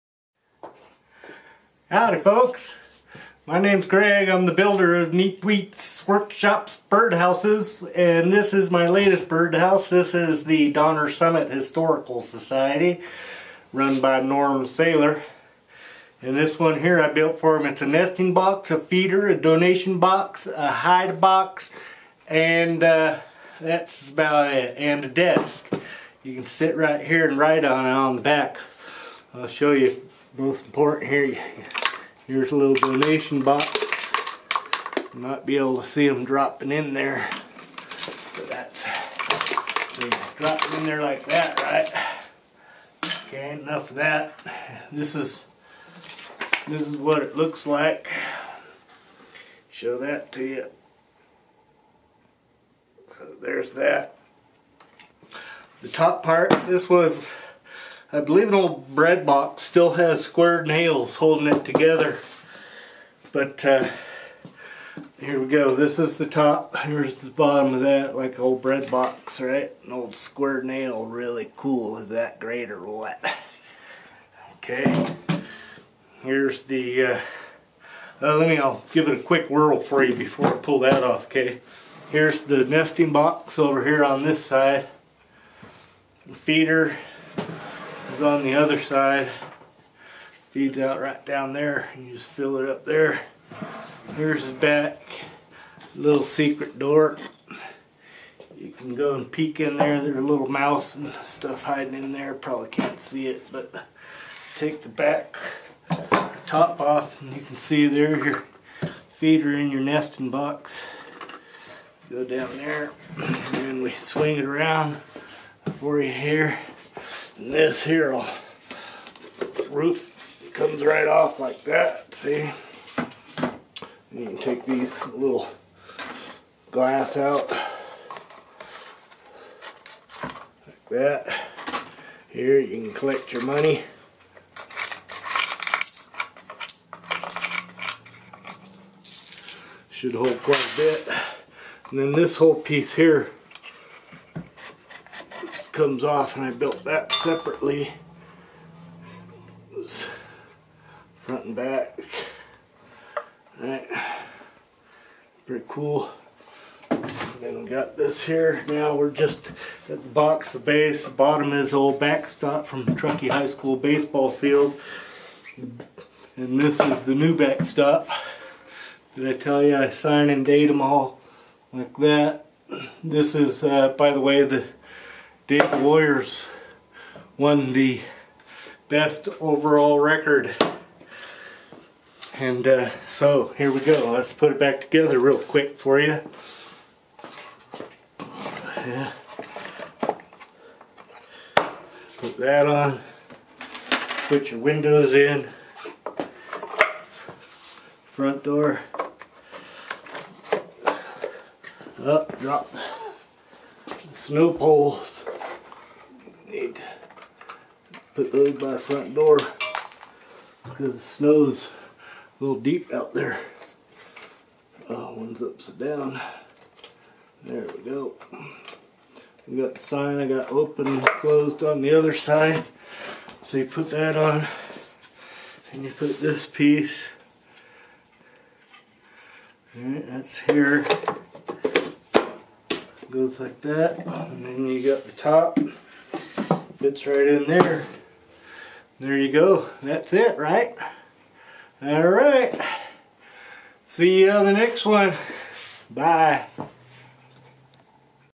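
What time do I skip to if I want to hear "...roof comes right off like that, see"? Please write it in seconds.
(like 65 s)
119 s.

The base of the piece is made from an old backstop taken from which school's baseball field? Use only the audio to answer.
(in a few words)
Truckee High School.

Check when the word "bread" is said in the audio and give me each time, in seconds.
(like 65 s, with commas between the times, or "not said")
58 s, 68 s.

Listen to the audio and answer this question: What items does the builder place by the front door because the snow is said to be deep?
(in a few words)
Snow poles.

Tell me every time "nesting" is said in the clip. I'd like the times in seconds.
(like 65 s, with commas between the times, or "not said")
17 s, 82 s, 109 s.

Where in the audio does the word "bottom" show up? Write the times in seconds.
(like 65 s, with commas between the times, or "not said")
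67 s, 161 s.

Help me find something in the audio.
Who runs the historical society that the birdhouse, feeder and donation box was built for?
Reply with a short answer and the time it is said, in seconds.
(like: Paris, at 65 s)
Norm Sayler, at 14 s.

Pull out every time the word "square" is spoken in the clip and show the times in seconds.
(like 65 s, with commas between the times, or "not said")
60 s, 70 s.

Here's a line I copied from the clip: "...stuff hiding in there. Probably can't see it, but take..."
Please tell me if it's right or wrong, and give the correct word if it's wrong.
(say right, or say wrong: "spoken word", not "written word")
right.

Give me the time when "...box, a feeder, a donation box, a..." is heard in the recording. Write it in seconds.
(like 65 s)
18 s.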